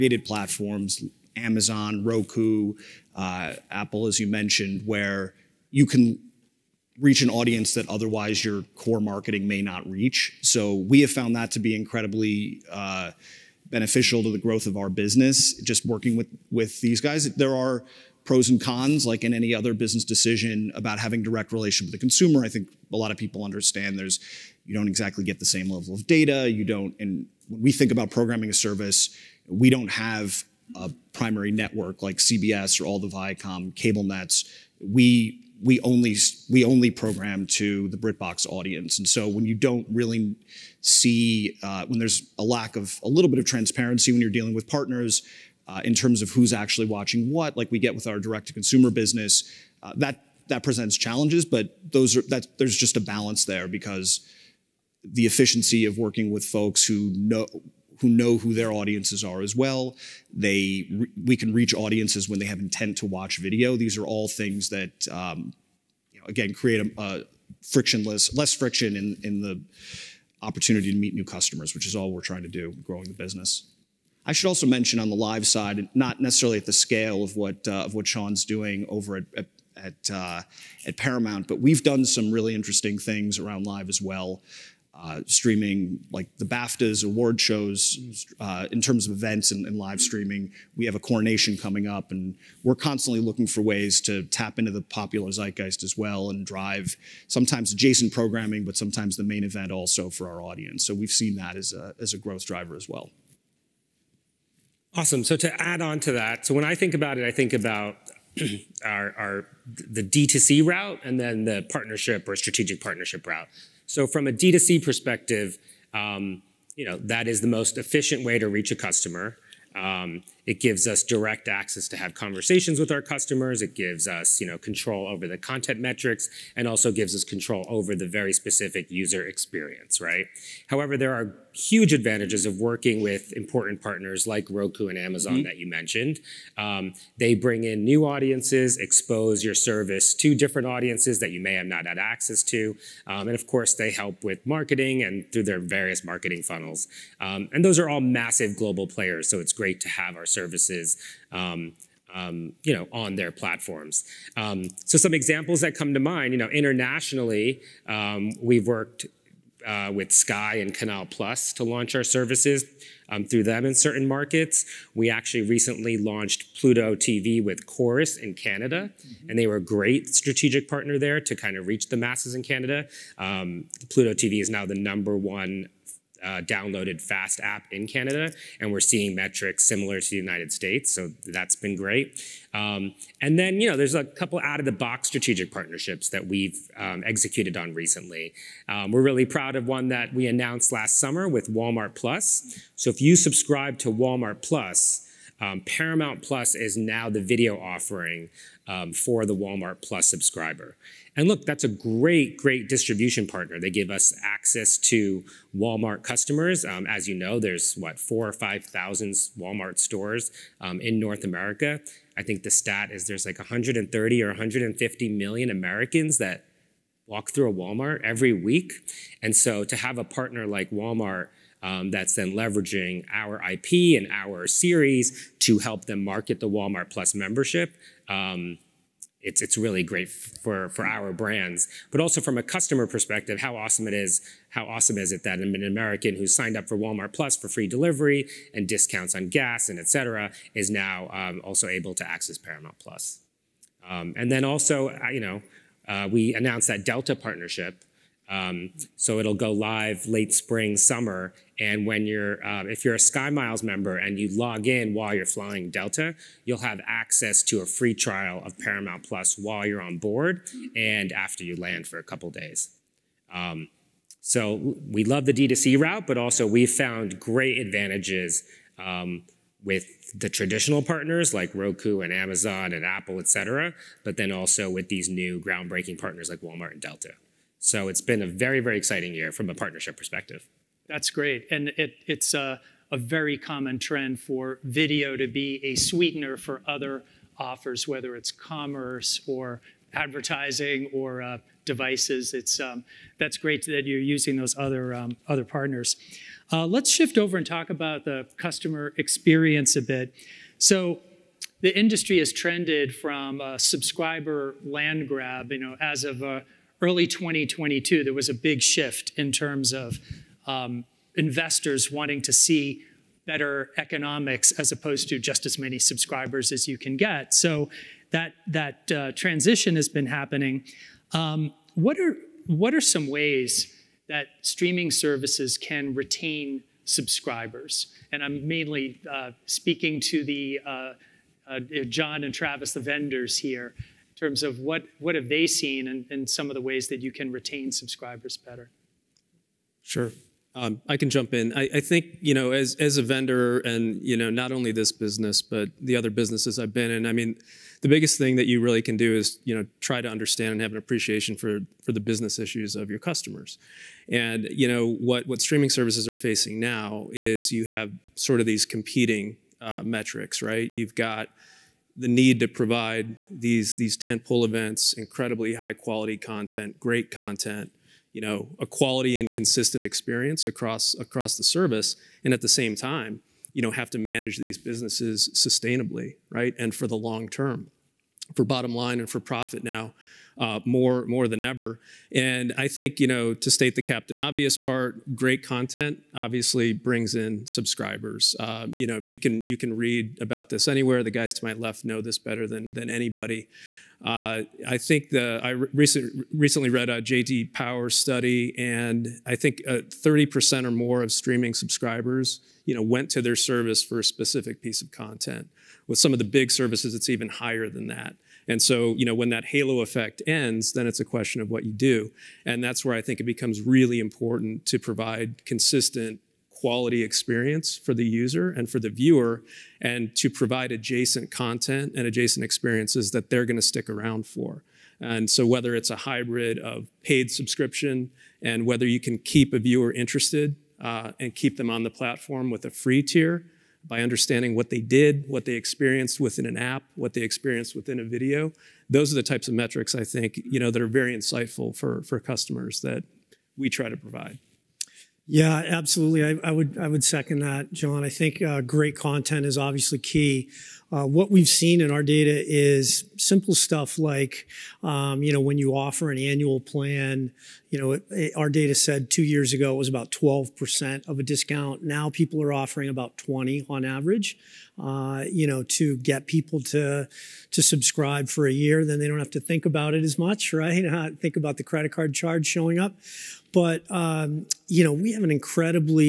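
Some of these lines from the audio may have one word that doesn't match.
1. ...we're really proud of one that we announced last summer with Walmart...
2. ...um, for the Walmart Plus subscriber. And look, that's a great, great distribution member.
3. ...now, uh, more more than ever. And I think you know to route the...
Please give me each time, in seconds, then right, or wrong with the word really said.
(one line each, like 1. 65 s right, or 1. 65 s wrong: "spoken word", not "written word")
1. 188 s right
2. 198 s wrong: "partner", not "member"
3. 379 s wrong: "state", not "route".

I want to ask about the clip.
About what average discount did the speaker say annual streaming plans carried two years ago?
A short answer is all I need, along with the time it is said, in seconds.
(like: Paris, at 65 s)
12%, at 460 s.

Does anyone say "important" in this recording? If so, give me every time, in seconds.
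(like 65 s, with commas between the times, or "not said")
133 s, 413 s.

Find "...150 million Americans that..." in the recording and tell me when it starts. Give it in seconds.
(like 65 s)
214 s.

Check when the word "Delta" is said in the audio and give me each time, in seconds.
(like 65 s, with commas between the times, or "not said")
246 s, 255 s, 276 s.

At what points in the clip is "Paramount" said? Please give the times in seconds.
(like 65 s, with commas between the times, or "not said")
80 s, 195 s, 242 s, 258 s.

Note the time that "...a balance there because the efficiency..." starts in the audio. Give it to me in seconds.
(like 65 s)
52 s.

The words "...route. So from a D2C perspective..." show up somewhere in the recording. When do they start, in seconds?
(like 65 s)
113 s.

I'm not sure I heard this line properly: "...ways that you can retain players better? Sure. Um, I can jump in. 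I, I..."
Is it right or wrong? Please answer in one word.
wrong.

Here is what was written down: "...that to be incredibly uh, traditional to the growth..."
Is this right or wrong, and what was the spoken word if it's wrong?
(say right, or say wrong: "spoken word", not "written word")
wrong: "beneficial", not "traditional".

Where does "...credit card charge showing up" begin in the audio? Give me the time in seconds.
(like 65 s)
471 s.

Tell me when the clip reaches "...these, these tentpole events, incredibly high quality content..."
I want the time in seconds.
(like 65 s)
363 s.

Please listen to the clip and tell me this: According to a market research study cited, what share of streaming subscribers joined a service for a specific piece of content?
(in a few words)
30%.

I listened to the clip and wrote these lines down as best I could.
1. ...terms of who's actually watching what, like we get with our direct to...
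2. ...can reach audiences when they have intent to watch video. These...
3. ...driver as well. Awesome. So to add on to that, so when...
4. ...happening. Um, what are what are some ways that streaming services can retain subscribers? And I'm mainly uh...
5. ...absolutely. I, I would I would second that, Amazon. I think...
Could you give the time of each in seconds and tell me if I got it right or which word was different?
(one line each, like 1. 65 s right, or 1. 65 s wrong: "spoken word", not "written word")
1. 45 s right
2. 61 s right
3. 102 s right
4. 320 s right
5. 445 s wrong: "John", not "Amazon".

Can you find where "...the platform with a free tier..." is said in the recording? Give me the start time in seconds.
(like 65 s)
431 s.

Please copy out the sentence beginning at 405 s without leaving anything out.
With some of the big services, it's even higher than that.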